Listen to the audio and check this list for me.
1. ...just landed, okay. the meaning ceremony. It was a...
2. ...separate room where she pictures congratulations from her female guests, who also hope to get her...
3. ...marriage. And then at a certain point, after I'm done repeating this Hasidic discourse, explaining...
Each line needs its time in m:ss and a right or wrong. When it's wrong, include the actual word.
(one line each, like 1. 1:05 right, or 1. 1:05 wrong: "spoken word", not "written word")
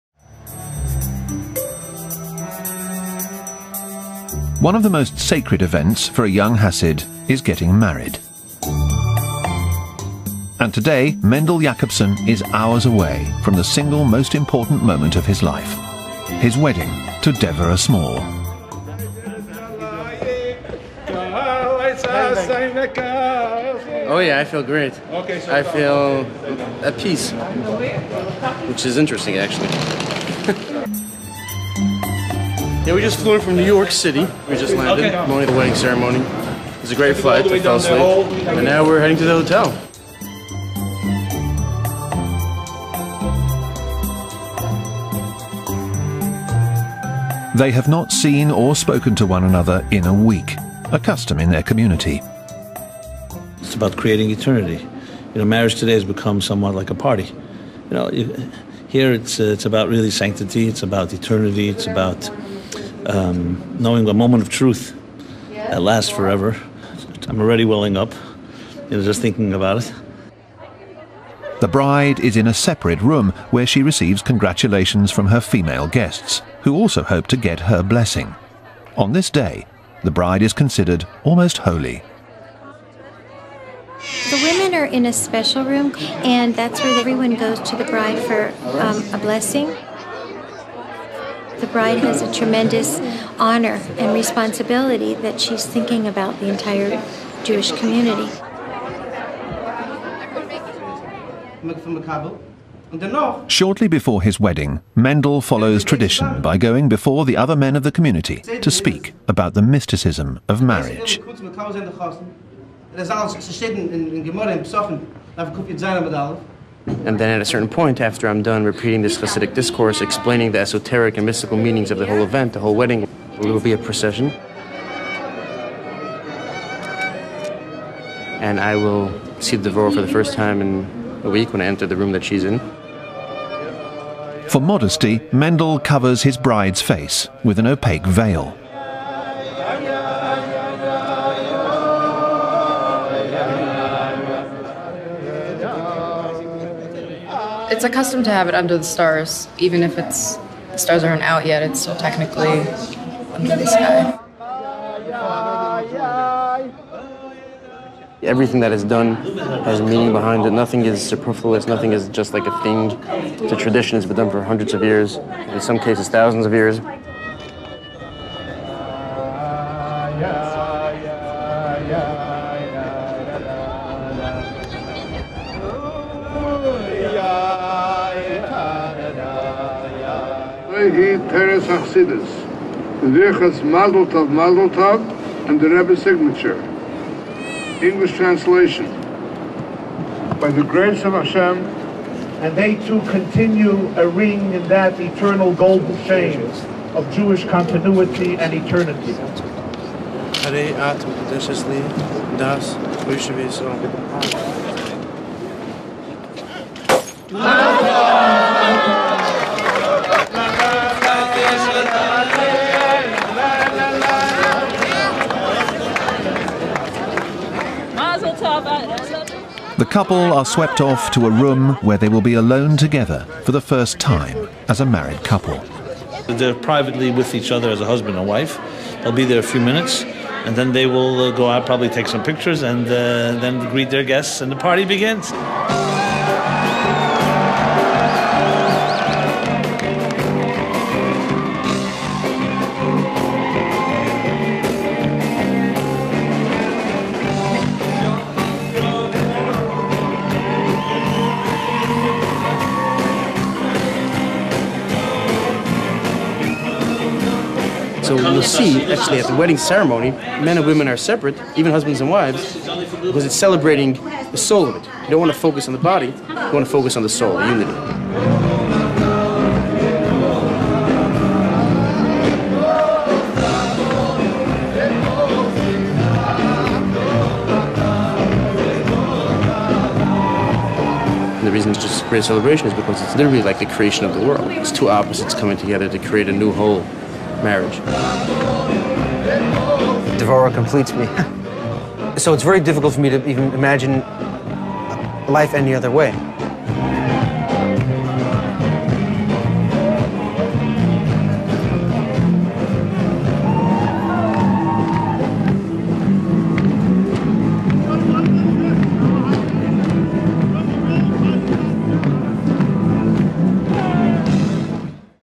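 1. 0:34 wrong: "wedding", not "meaning"
2. 1:12 wrong: "receives", not "pictures"
3. 1:50 right.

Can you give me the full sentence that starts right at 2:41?
Nothing is just like a thing.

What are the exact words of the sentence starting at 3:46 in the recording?
They're privately with each other as a husband and wife.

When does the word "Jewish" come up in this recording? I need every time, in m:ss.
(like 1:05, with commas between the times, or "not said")
1:37, 3:17.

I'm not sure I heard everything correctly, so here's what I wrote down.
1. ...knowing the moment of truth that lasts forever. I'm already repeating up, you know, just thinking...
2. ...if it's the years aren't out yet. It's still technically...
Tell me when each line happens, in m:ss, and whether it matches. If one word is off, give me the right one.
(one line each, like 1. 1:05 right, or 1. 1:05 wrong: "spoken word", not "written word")
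1. 1:03 wrong: "welling", not "repeating"
2. 2:29 wrong: "stars", not "years".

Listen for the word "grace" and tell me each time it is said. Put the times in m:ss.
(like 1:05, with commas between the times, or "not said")
3:10.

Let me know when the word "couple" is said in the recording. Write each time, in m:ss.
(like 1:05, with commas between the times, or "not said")
3:39, 3:45.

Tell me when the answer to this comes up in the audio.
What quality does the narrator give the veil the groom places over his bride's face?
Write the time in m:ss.
2:17.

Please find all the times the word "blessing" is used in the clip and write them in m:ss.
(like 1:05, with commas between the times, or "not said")
1:17, 1:29.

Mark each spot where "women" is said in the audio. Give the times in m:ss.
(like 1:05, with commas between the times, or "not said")
1:24, 4:20.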